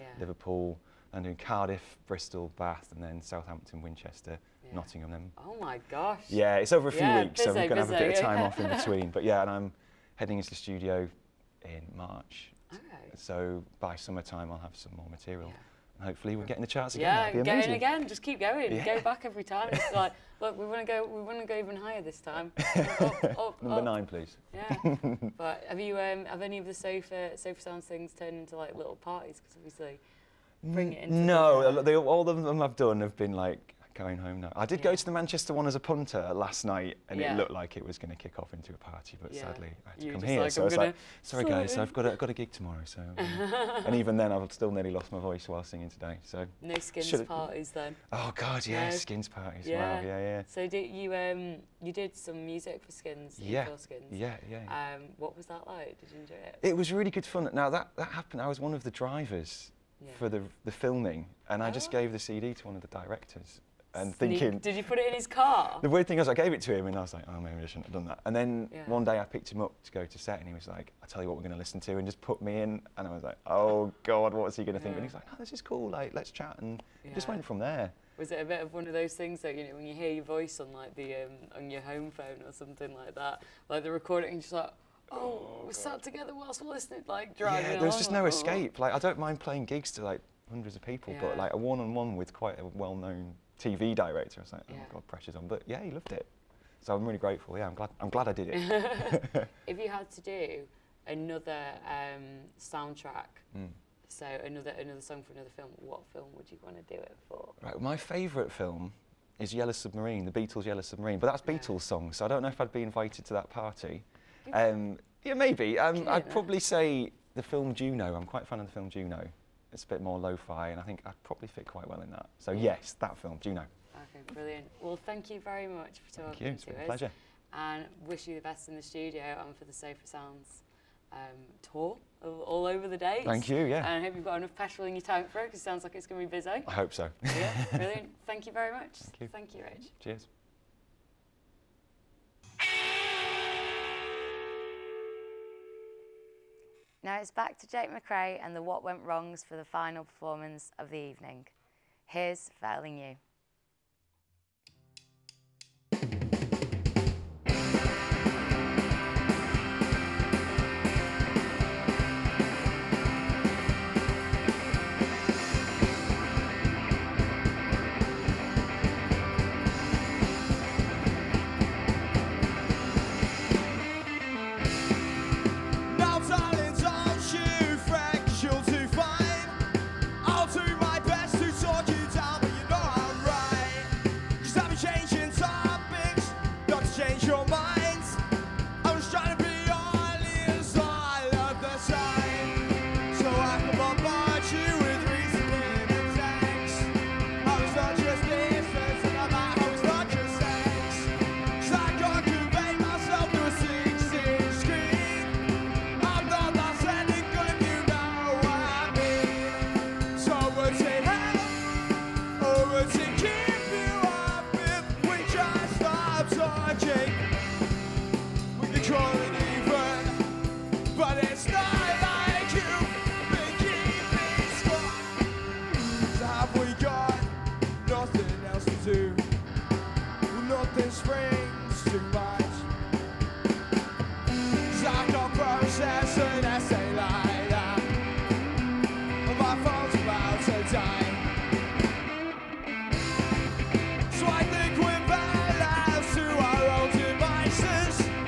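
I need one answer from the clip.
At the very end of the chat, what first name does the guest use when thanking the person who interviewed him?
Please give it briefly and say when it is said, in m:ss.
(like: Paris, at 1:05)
Rich, at 2:19.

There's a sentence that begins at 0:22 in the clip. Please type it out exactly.
up, up, up, Number nine, please.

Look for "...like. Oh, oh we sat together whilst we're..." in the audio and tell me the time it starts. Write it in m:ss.
1:24.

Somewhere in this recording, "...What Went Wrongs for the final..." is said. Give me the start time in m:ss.
2:28.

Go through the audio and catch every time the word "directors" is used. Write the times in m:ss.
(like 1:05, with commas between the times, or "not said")
1:02, 1:33.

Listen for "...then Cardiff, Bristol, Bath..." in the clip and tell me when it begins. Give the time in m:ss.
0:01.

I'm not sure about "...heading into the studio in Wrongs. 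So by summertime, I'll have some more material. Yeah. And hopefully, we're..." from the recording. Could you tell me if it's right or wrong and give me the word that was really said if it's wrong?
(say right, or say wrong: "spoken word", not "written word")
wrong: "March", not "Wrongs".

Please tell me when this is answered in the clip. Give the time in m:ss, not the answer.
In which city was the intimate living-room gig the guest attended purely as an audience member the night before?
0:35.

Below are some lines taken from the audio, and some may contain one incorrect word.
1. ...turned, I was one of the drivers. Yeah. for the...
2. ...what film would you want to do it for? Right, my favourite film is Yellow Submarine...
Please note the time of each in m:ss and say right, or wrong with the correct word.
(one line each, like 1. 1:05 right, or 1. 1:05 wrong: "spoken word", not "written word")
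1. 0:58 wrong: "happened", not "turned"
2. 1:45 right.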